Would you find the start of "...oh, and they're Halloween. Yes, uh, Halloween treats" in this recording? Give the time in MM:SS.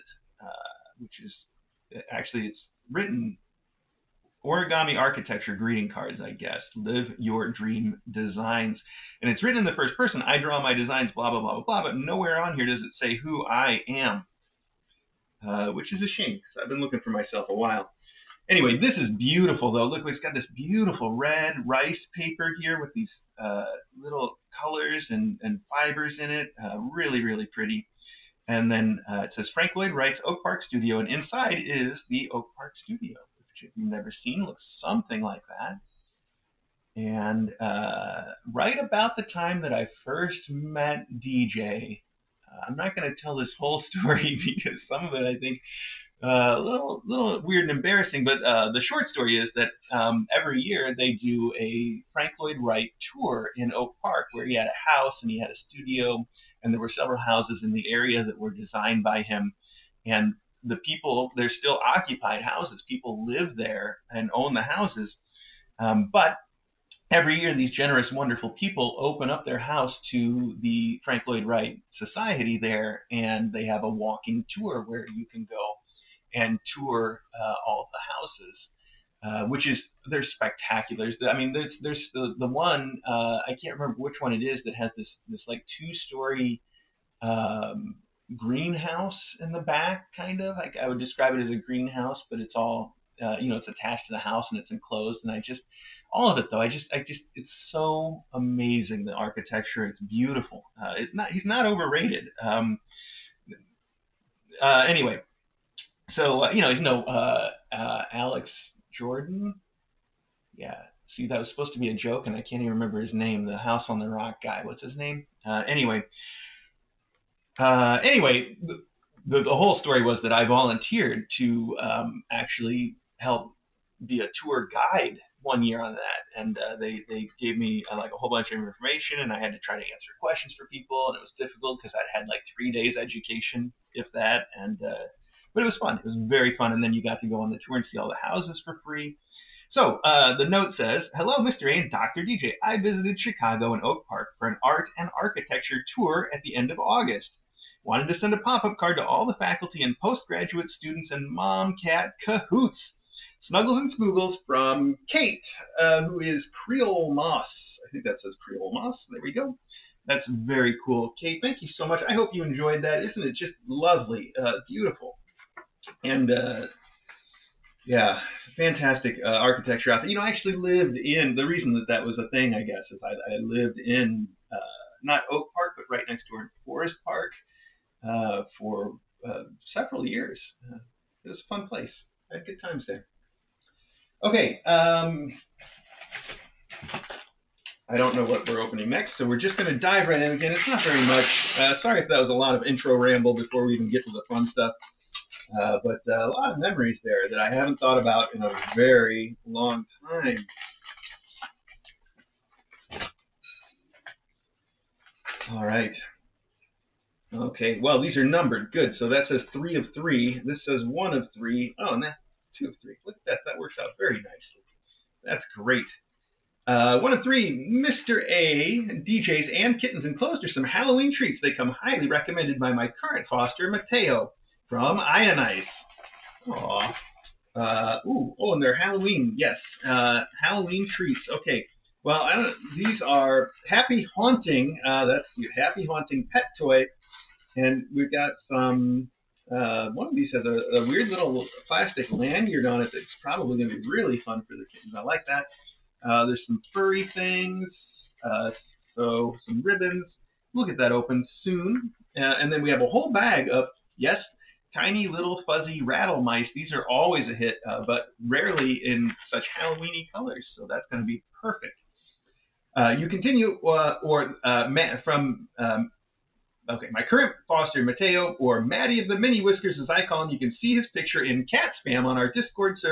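03:48.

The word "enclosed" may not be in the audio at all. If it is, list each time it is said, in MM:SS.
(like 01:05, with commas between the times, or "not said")
01:34, 03:40.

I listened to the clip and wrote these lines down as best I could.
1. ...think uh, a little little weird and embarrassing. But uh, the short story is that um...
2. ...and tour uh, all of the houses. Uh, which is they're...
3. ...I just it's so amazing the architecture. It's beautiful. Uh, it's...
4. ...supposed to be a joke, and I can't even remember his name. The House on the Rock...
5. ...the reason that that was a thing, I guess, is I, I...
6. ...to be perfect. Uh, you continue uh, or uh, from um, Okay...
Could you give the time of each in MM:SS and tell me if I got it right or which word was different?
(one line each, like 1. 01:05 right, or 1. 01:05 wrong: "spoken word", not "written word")
1. 00:45 right
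2. 01:16 right
3. 01:36 right
4. 01:51 right
5. 02:51 right
6. 04:21 right.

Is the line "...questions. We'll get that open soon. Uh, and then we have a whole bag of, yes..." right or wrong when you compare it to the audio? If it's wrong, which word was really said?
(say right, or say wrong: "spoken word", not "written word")
wrong: "ribbons", not "questions".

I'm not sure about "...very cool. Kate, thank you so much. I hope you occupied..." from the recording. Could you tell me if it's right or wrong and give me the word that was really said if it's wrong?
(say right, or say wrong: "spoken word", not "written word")
wrong: "enjoyed", not "occupied".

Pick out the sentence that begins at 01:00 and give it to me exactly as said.
And the people they're still occupied houses.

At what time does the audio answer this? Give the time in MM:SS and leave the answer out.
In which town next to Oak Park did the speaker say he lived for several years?
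02:56.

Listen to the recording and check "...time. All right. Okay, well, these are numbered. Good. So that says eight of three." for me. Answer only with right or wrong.
wrong.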